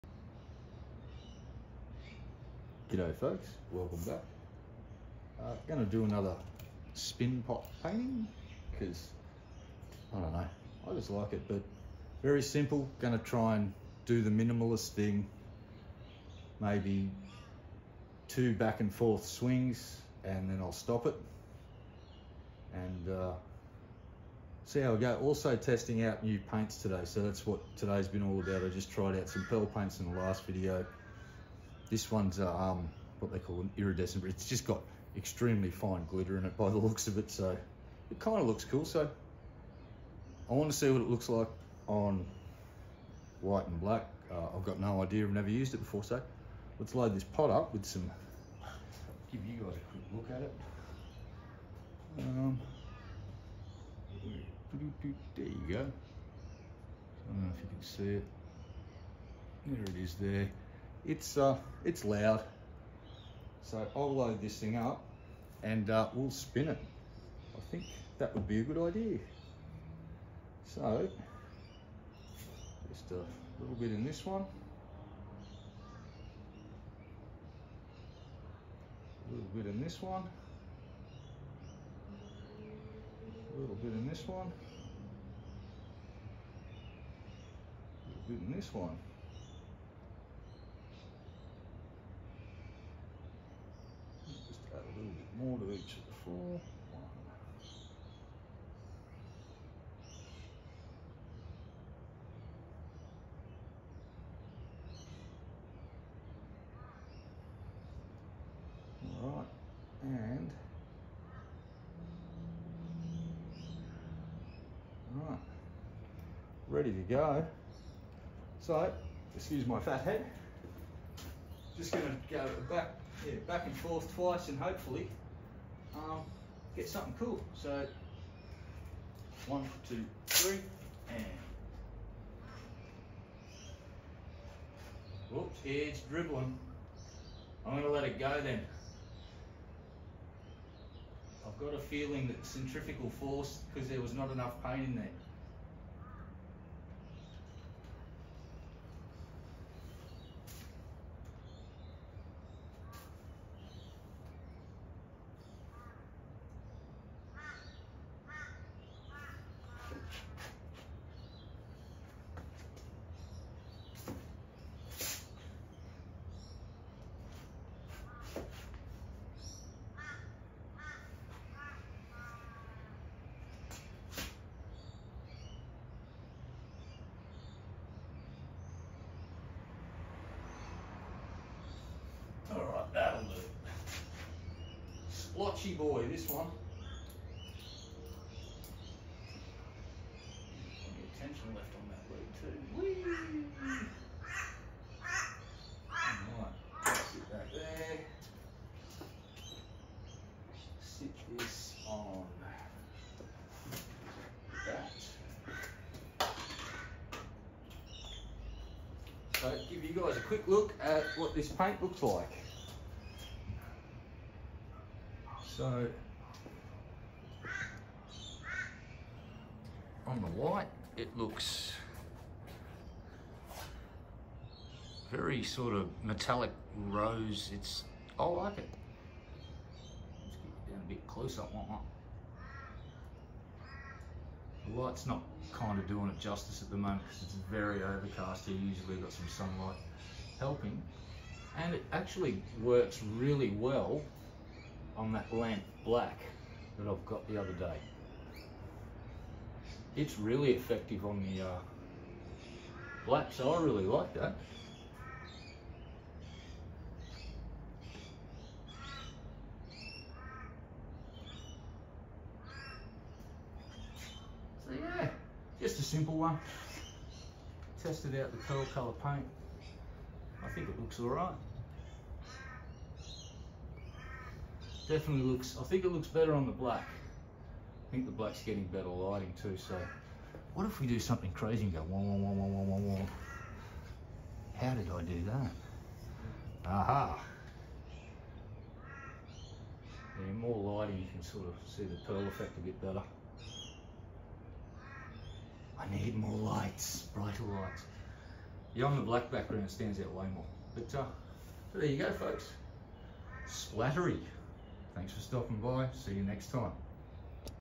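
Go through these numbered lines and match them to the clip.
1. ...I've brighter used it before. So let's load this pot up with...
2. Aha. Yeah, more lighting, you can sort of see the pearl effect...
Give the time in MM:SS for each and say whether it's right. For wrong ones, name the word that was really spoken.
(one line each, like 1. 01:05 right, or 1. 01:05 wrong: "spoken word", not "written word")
1. 00:45 wrong: "never", not "brighter"
2. 04:46 right.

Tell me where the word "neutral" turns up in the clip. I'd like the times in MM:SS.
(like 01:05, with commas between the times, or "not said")
not said.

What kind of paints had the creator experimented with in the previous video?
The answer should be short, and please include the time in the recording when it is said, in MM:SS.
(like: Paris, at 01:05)
pearl paints, at 00:29.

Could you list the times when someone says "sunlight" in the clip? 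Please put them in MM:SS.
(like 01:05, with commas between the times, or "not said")
03:59.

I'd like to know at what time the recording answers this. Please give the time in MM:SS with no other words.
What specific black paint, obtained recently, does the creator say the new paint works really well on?
04:05.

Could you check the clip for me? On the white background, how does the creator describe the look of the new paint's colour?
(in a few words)
metallic rose.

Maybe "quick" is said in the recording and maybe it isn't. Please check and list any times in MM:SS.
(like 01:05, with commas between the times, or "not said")
00:49, 03:30.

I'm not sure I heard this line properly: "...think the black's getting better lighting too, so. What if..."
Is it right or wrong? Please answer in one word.
right.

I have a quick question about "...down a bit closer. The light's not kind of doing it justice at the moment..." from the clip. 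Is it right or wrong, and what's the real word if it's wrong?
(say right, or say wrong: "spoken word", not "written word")
right.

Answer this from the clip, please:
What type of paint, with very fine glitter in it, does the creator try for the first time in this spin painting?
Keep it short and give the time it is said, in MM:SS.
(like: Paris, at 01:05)
iridescent, at 00:33.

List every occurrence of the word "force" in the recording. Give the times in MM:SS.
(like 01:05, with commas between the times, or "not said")
02:23.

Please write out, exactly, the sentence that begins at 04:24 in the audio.
So yeah, just a simple one.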